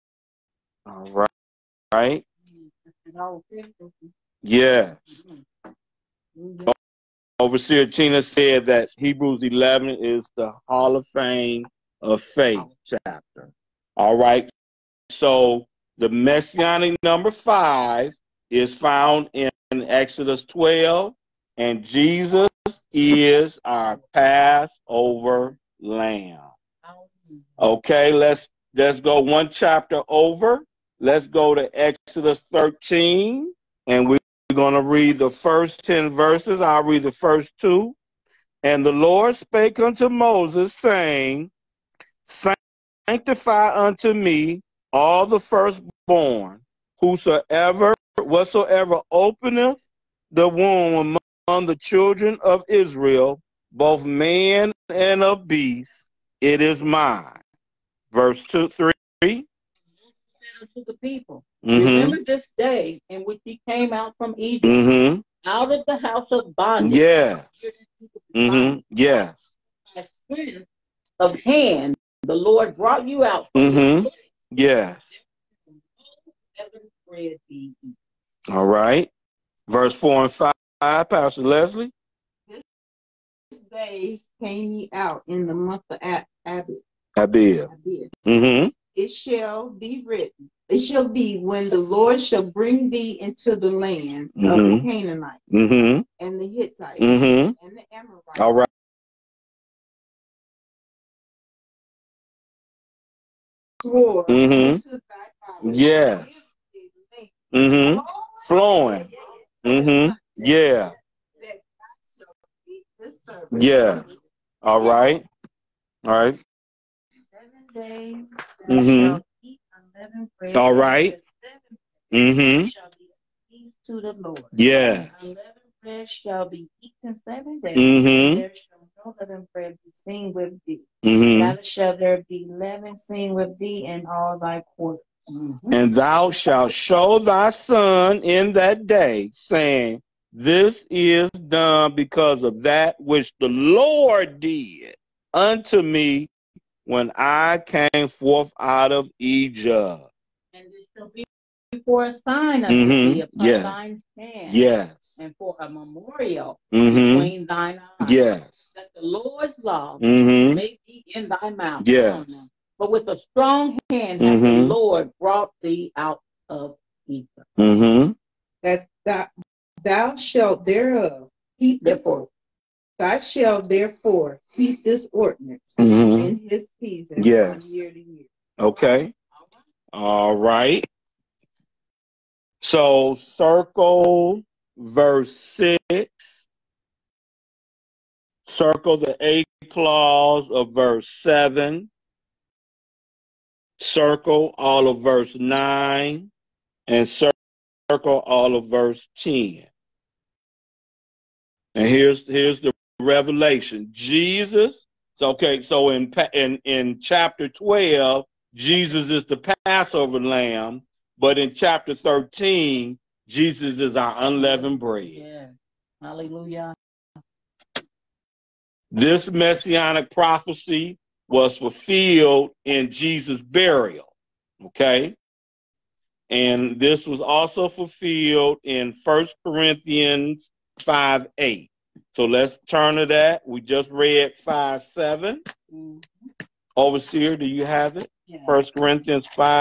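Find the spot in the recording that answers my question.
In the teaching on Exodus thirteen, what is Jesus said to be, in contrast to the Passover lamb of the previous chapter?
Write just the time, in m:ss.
3:34.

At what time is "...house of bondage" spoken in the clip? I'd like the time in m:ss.
1:06.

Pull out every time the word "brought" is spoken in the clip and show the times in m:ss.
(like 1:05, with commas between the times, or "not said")
1:12, 2:45.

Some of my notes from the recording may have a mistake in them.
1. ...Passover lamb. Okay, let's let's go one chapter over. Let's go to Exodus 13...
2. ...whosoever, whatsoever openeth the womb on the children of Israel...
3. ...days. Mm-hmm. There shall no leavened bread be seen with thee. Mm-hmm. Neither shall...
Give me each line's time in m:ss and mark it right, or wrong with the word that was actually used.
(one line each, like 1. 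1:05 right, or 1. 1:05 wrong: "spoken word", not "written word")
1. 0:24 right
2. 0:46 right
3. 2:07 right.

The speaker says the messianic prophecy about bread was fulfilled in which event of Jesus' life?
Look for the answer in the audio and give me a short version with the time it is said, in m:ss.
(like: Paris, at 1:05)
burial, at 3:42.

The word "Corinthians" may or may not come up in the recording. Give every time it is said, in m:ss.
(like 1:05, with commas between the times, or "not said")
3:49, 3:58.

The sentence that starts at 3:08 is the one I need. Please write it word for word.
Circle the A clause of verse seven.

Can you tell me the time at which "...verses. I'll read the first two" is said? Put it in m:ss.
0:36.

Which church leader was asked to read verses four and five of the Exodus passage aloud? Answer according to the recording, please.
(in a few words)
Pastor Leslie.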